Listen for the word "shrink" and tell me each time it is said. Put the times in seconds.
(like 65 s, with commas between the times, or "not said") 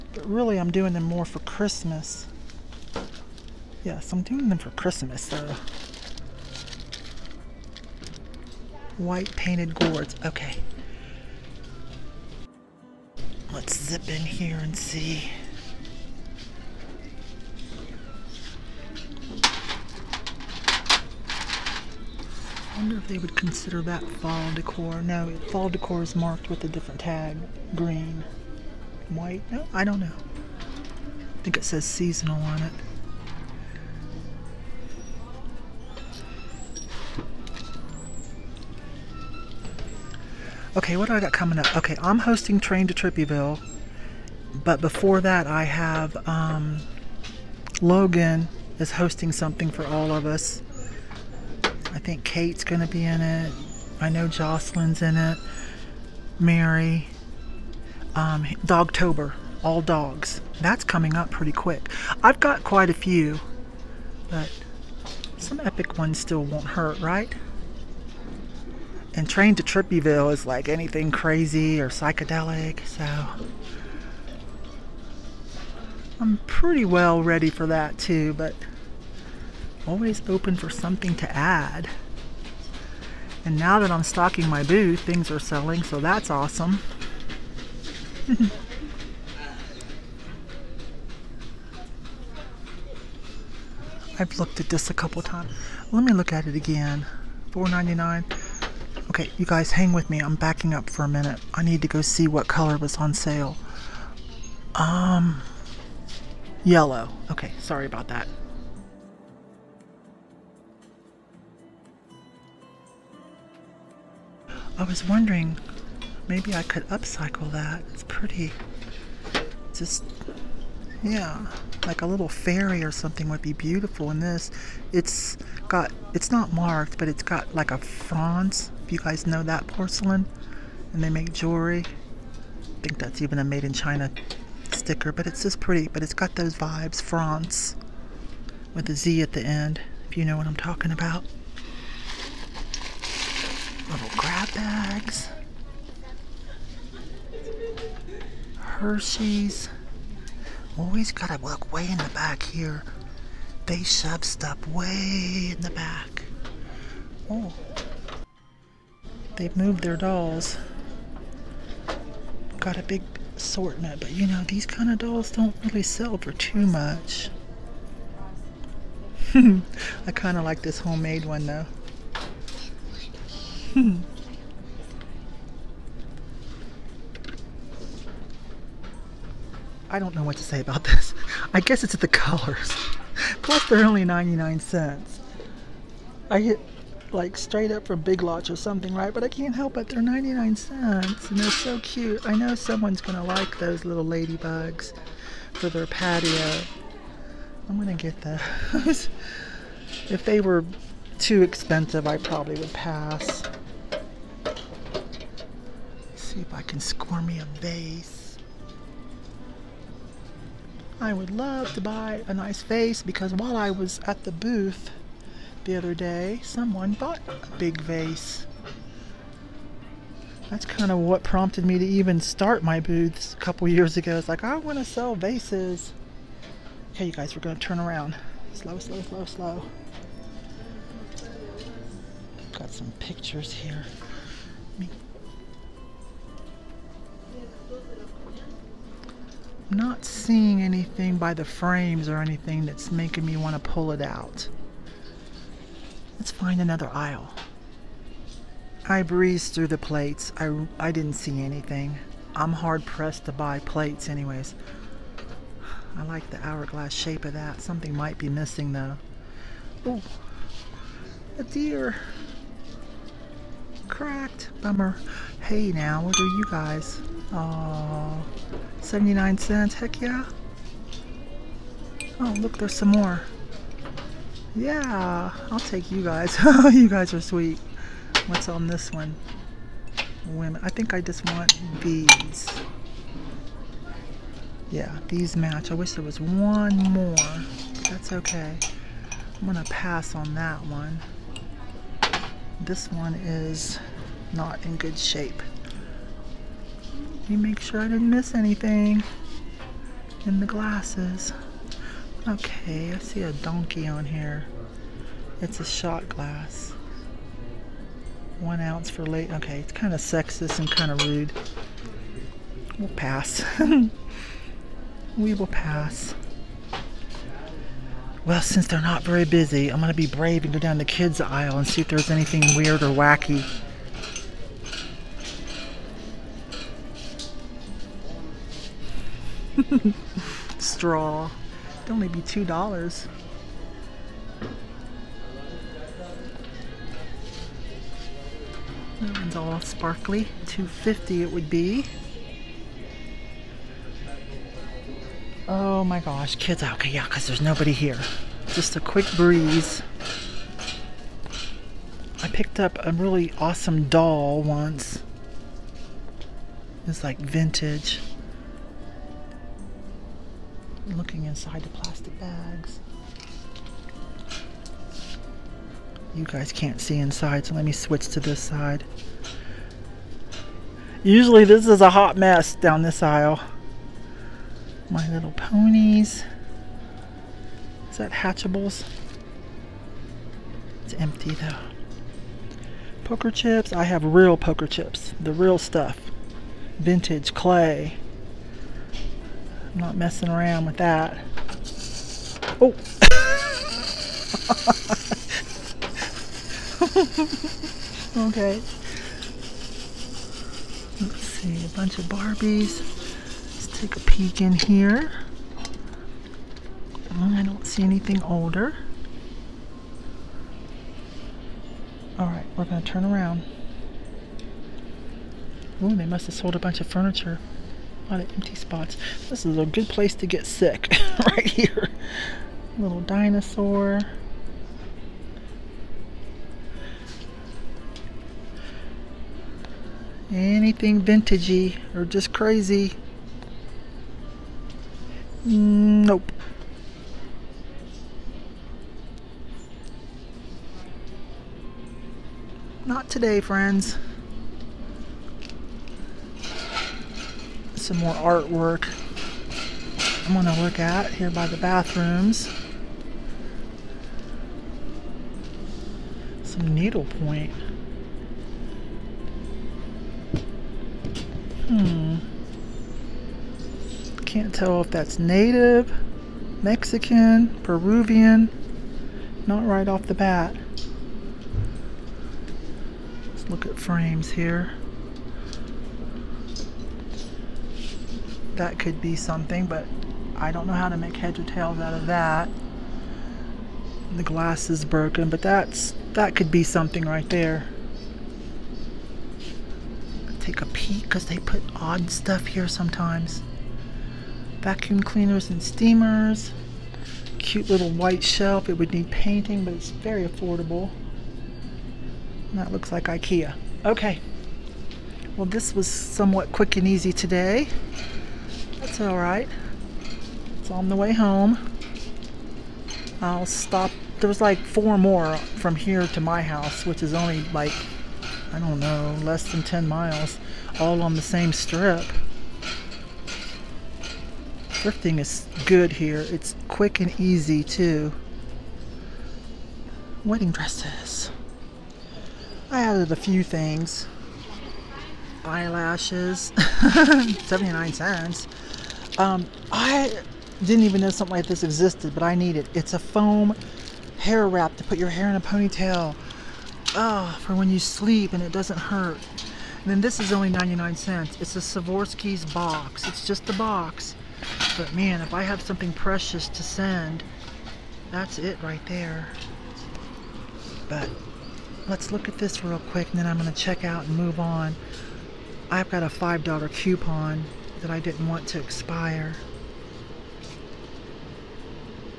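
not said.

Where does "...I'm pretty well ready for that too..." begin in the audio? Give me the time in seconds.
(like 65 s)
76 s.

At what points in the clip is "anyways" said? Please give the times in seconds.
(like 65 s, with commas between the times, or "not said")
254 s.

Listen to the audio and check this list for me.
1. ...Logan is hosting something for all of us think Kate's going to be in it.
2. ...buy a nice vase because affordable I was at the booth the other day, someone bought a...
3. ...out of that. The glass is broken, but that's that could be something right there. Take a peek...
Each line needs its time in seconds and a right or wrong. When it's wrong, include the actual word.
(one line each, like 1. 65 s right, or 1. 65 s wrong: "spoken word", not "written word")
1. 47 s right
2. 211 s wrong: "while", not "affordable"
3. 481 s right.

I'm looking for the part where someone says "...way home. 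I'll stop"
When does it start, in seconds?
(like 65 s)
510 s.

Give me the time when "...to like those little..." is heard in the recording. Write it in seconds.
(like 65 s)
193 s.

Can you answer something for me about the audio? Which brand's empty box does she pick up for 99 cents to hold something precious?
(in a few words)
Swarovski.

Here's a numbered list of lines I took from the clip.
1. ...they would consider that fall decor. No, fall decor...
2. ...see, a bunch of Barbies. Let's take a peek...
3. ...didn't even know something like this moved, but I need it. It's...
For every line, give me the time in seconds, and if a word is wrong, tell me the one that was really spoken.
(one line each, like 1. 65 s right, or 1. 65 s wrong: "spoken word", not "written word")
1. 23 s right
2. 401 s right
3. 540 s wrong: "existed", not "moved".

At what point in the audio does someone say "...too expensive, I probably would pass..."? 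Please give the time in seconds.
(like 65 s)
201 s.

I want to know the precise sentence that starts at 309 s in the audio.
Okay, it's kind of sexist and kind of rude.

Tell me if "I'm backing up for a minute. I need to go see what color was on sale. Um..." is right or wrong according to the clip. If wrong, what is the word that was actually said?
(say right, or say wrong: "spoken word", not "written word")
right.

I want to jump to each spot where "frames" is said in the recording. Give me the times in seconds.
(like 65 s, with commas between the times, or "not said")
241 s, 473 s.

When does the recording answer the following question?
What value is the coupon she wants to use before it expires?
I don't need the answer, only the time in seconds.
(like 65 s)
566 s.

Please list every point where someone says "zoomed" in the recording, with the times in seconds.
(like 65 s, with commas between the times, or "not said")
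not said.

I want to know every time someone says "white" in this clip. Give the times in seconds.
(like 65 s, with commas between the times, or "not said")
8 s, 29 s, 497 s.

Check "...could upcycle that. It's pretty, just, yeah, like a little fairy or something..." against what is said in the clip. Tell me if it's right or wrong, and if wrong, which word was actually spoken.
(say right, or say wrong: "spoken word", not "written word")
right.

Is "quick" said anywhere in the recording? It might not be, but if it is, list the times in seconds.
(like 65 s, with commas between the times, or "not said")
61 s, 348 s, 506 s, 526 s, 562 s.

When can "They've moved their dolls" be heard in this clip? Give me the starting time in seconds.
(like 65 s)
159 s.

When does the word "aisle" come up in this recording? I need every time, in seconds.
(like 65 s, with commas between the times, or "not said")
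246 s, 321 s, 373 s.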